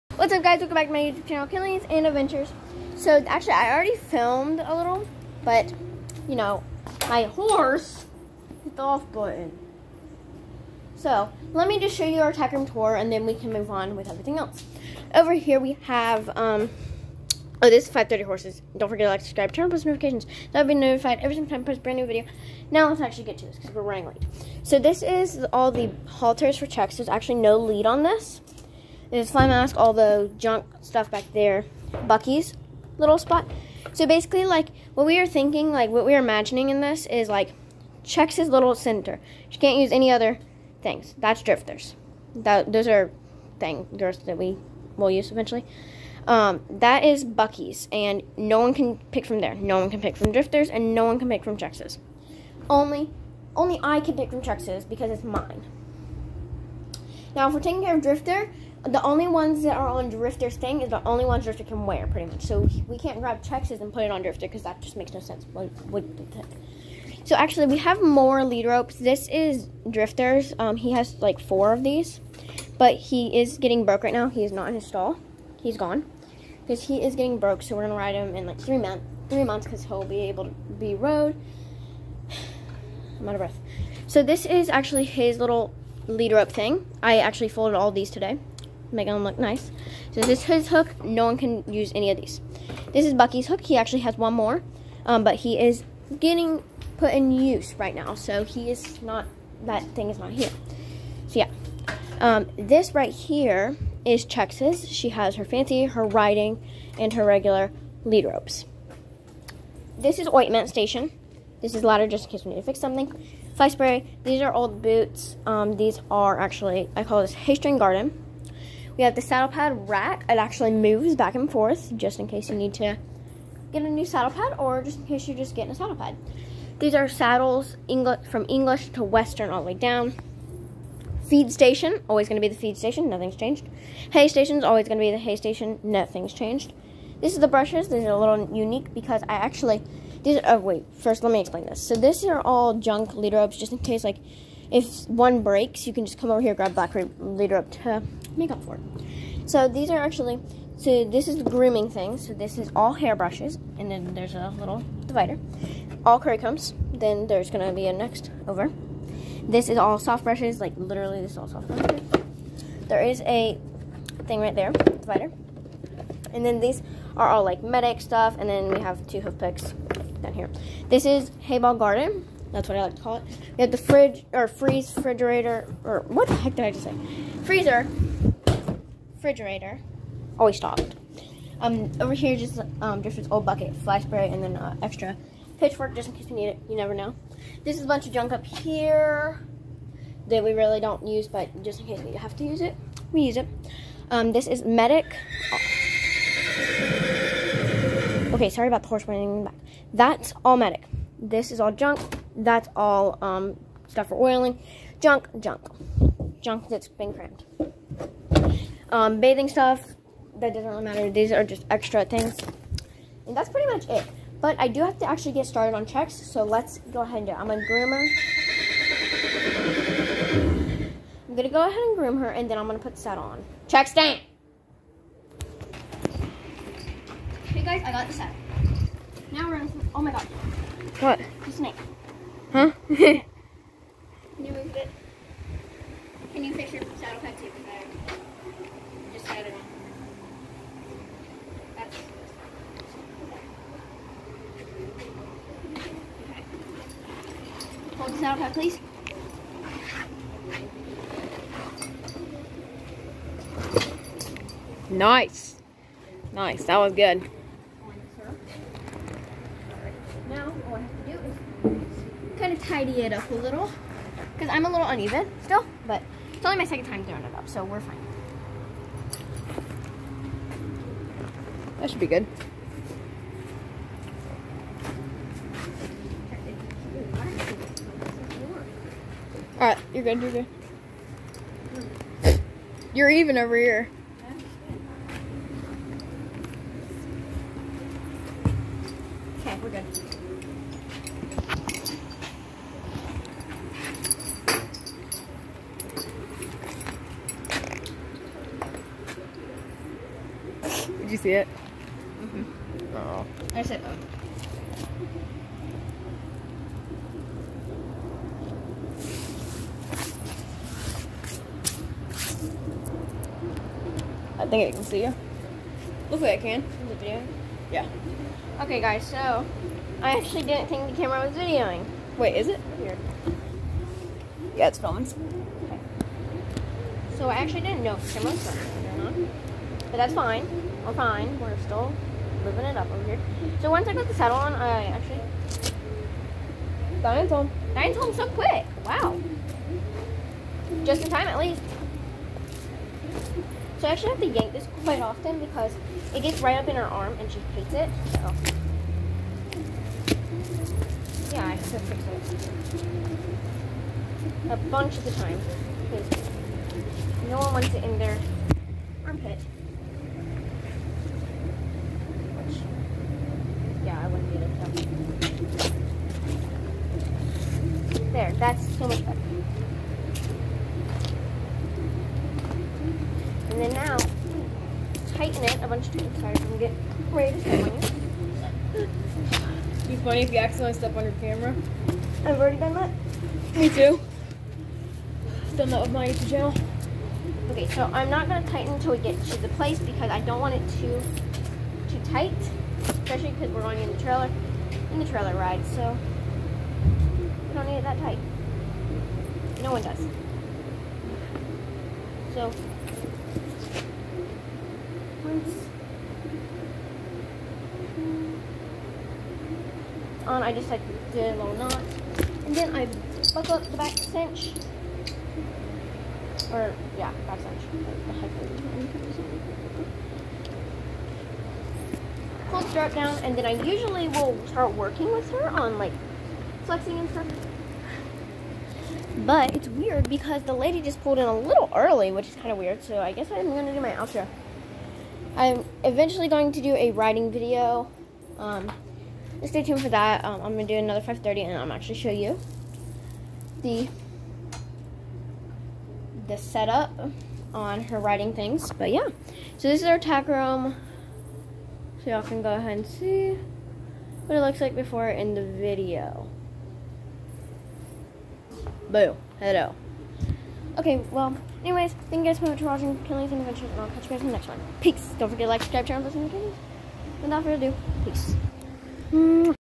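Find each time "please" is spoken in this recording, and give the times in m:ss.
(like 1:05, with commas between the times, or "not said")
4:08.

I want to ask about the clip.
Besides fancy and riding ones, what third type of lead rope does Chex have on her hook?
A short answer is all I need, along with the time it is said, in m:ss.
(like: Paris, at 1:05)
regular, at 1:47.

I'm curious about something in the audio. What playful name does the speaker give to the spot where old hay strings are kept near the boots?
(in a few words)
Haystring Garden.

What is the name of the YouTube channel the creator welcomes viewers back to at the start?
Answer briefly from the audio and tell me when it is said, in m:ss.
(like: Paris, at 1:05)
Killings and Adventures, at 0:01.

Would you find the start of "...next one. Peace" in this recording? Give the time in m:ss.
7:44.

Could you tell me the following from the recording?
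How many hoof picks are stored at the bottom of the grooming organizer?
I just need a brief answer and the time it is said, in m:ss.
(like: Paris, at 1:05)
2, at 2:49.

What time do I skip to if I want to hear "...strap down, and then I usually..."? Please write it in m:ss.
7:02.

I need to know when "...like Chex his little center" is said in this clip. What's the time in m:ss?
0:37.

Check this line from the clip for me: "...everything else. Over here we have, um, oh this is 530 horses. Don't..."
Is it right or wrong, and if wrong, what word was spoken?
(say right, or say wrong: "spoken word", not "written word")
right.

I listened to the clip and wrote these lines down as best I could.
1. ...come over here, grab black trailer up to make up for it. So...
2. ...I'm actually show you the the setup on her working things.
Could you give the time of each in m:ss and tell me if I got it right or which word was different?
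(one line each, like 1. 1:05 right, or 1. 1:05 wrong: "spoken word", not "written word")
1. 2:26 wrong: "leader", not "trailer"
2. 7:21 wrong: "riding", not "working".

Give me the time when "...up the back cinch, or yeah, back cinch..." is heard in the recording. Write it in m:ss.
6:53.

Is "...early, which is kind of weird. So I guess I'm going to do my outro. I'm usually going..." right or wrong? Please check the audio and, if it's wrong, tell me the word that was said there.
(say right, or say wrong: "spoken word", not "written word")
wrong: "eventually", not "usually".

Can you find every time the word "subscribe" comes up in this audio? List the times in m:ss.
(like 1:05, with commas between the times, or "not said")
0:19, 7:45.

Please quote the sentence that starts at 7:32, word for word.
So y'all can go ahead and see what it looks like before in the video.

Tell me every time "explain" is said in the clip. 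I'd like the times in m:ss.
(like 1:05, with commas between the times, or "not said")
2:21.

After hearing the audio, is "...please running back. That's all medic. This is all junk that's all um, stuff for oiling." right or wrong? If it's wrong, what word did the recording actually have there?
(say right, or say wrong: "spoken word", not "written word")
wrong: "horse", not "please".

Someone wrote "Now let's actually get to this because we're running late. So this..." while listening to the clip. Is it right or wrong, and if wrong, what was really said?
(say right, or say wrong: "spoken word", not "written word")
right.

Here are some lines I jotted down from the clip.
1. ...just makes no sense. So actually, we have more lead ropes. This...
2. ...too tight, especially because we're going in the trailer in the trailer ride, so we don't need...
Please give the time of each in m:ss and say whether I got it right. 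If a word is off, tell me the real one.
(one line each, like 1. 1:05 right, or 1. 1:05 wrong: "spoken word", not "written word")
1. 1:04 right
2. 6:31 right.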